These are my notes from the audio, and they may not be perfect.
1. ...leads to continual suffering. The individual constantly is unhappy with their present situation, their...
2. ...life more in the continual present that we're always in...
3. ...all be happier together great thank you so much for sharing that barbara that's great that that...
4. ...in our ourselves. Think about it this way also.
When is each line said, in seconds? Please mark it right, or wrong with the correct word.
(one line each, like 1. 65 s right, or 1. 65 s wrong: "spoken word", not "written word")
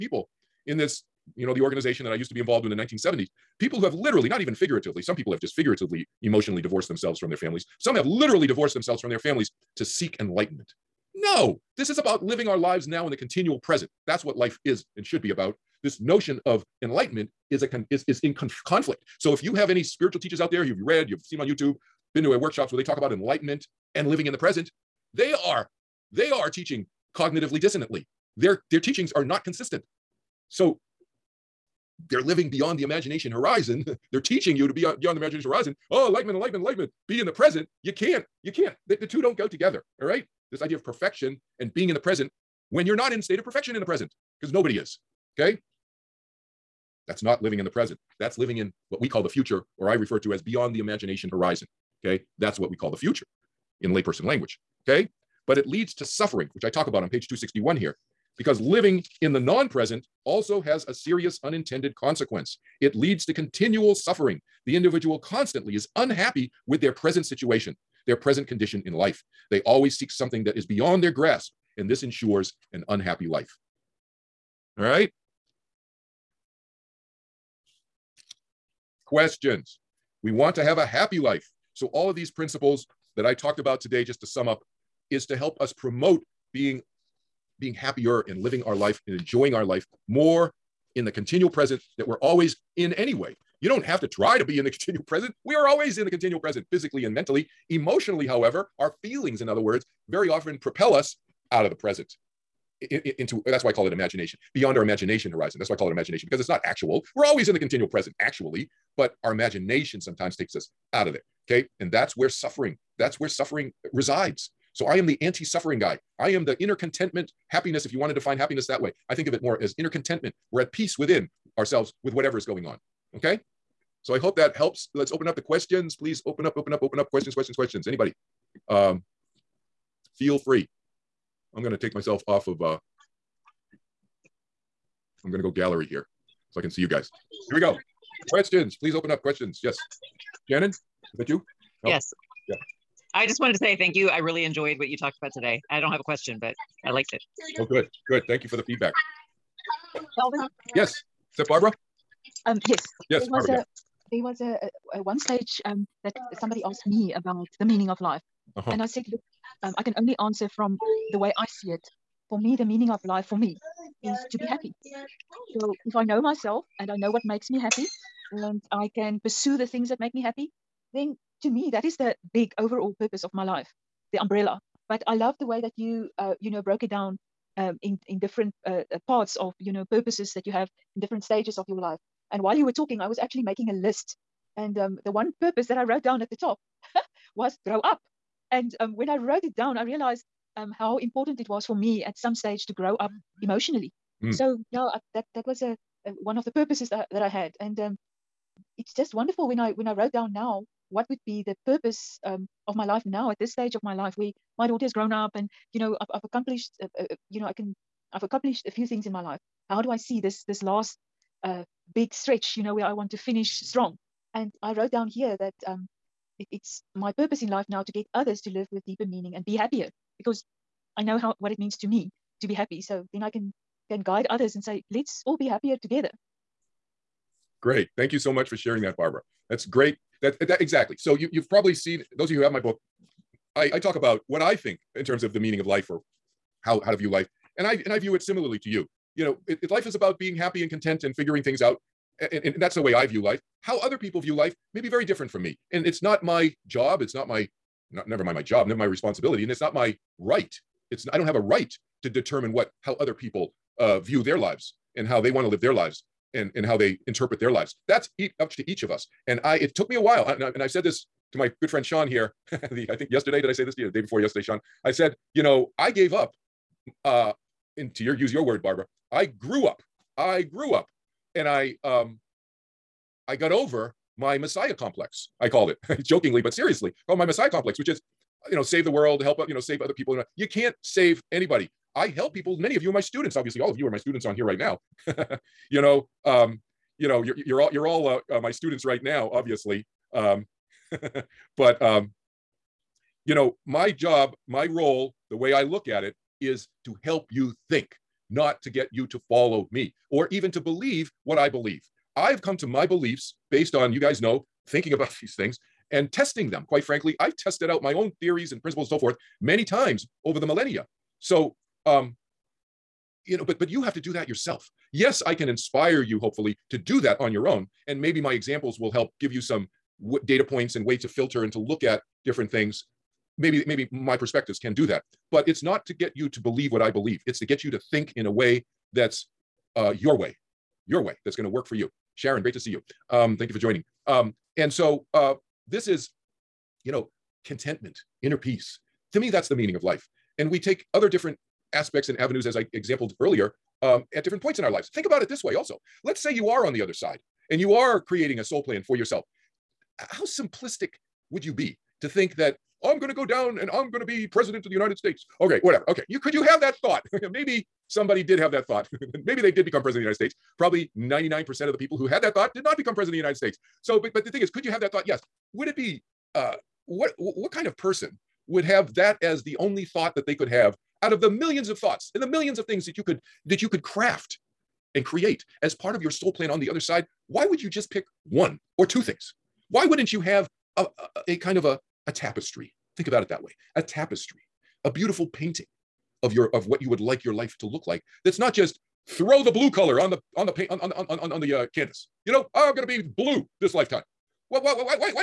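1. 62 s right
2. 89 s right
3. 225 s right
4. 344 s wrong: "lives", not "ourselves".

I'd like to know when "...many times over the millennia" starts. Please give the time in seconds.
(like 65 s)
309 s.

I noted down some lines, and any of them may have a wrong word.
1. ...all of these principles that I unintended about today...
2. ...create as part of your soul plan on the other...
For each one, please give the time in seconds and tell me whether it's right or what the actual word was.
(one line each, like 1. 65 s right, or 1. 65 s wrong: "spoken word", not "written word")
1. 81 s wrong: "talked", not "unintended"
2. 375 s right.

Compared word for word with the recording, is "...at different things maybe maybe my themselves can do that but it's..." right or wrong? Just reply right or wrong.
wrong.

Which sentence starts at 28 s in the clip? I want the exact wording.
Their, their teachings are not consistent.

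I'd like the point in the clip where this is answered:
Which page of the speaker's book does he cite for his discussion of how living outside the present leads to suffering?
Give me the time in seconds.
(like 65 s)
57 s.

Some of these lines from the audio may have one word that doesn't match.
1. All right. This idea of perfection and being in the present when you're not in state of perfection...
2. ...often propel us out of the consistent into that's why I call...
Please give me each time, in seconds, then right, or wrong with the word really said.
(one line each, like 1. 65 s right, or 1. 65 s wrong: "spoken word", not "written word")
1. 40 s right
2. 100 s wrong: "present", not "consistent".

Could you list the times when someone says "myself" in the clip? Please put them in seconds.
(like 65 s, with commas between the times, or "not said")
131 s, 166 s.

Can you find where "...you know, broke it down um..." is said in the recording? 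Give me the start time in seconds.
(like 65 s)
176 s.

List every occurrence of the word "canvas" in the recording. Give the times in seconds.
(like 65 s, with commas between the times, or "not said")
391 s.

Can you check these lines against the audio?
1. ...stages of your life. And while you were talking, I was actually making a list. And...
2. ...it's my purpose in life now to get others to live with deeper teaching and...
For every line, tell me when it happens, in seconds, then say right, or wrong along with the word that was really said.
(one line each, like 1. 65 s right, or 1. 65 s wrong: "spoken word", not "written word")
1. 181 s right
2. 216 s wrong: "meaning", not "teaching".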